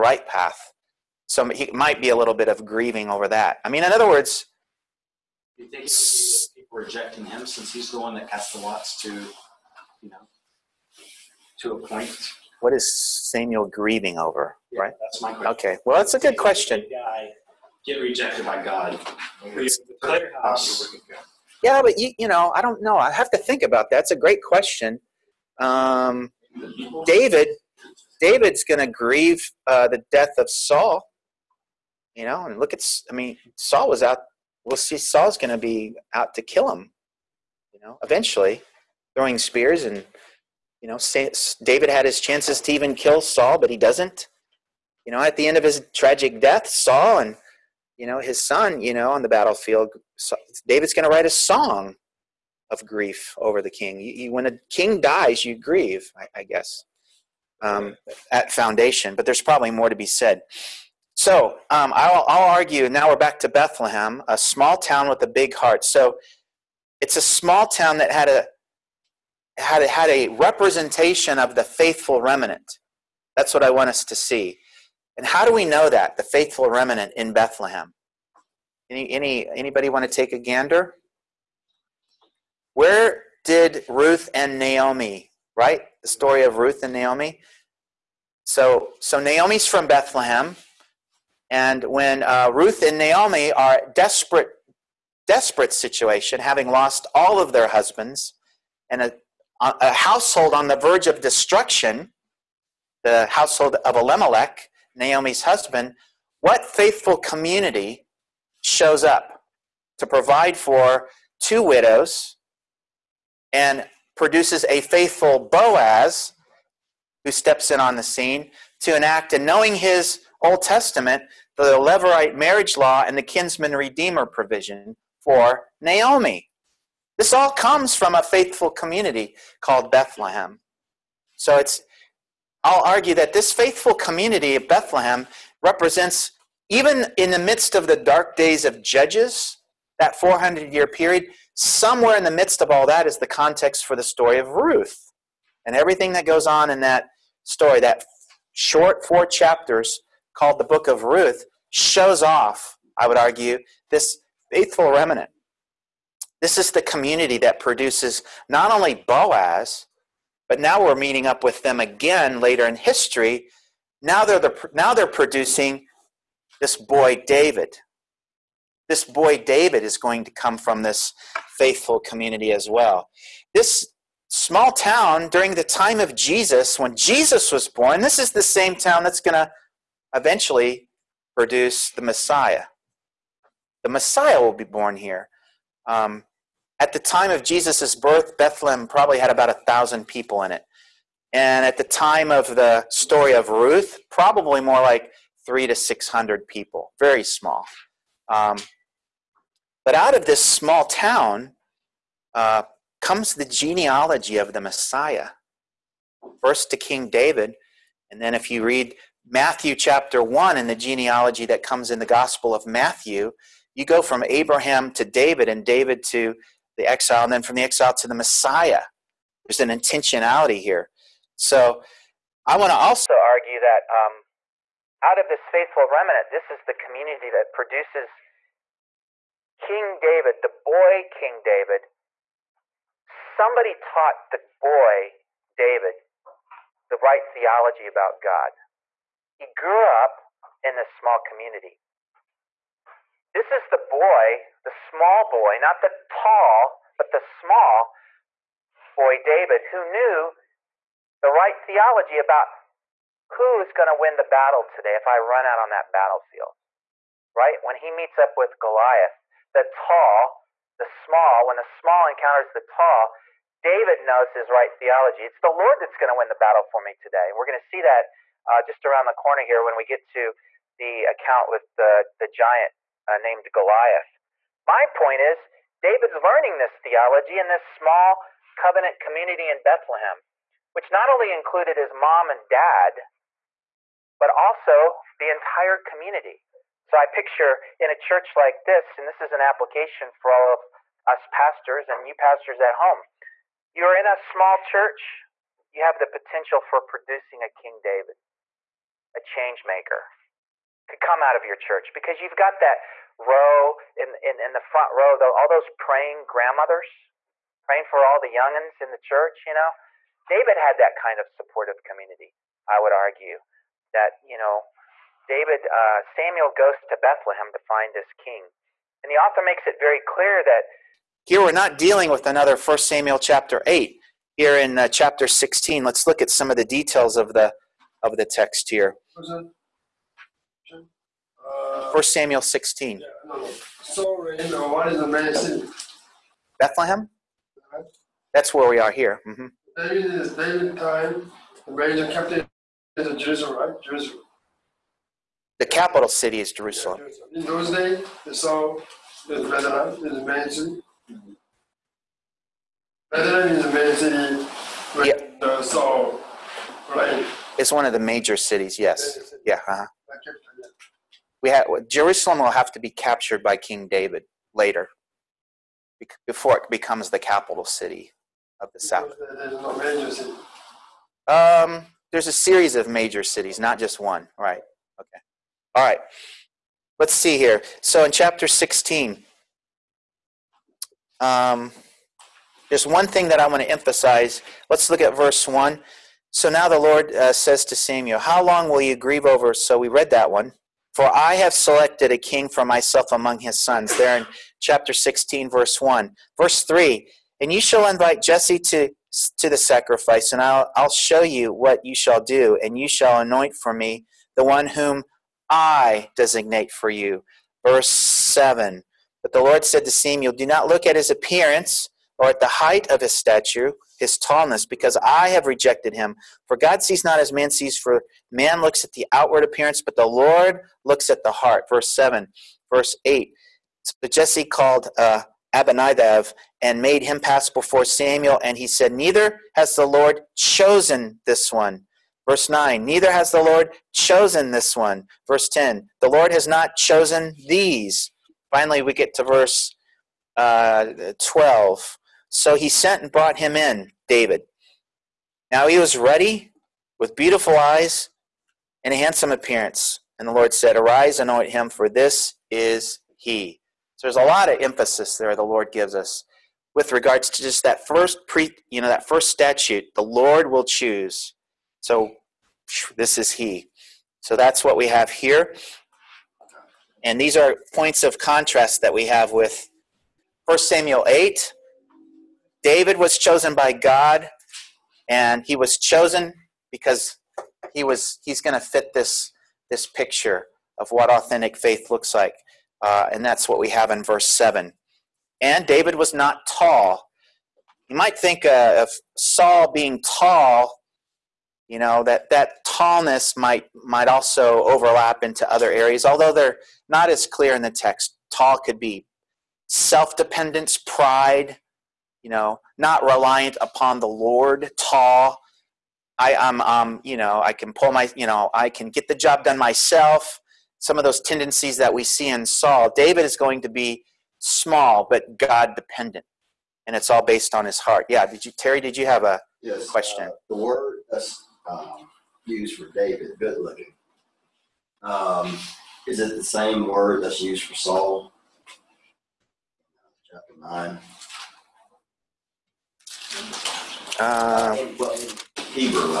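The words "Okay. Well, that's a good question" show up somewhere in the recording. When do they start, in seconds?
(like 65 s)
15 s.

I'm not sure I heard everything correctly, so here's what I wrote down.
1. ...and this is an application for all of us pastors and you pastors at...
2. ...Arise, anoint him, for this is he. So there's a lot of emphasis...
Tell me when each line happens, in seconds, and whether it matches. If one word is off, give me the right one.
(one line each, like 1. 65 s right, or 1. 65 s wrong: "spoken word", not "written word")
1. 288 s right
2. 450 s right.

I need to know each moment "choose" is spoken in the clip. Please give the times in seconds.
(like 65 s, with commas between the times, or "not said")
460 s.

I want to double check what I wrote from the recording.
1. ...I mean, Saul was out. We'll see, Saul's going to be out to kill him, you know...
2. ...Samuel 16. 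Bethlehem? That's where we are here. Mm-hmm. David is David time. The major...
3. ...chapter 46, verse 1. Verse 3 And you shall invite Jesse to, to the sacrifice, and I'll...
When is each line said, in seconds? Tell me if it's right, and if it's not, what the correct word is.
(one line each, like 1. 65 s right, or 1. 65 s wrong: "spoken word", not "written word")
1. 33 s right
2. 332 s right
3. 394 s wrong: "16", not "46".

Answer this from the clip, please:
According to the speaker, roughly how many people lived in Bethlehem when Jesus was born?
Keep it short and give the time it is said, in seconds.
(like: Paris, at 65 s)
about 1000, at 189 s.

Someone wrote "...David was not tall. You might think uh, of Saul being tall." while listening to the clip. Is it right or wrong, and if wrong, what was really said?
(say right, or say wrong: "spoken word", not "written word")
right.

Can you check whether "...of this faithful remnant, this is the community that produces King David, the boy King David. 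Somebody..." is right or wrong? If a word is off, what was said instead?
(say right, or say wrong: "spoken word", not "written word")
right.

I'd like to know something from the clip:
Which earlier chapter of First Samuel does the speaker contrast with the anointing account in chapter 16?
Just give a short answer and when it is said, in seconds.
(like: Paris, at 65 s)
Chapter 8, at 323 s.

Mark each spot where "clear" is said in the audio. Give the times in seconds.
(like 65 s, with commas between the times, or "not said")
320 s, 497 s.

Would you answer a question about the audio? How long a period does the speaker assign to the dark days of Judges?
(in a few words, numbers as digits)
400 years.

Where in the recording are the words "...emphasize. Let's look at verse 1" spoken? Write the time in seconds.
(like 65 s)
383 s.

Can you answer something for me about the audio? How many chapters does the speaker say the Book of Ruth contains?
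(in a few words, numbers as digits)
4.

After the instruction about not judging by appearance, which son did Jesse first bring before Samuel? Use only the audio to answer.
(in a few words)
Abinadab.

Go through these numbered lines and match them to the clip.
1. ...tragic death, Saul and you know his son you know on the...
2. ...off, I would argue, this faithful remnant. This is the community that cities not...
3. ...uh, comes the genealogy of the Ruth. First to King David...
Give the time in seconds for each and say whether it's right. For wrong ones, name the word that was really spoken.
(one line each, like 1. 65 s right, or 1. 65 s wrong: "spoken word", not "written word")
1. 45 s right
2. 152 s wrong: "produces", not "cities"
3. 202 s wrong: "Messiah", not "Ruth".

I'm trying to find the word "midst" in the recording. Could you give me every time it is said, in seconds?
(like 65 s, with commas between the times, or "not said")
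137 s, 142 s.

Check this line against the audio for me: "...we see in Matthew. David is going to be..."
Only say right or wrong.
wrong.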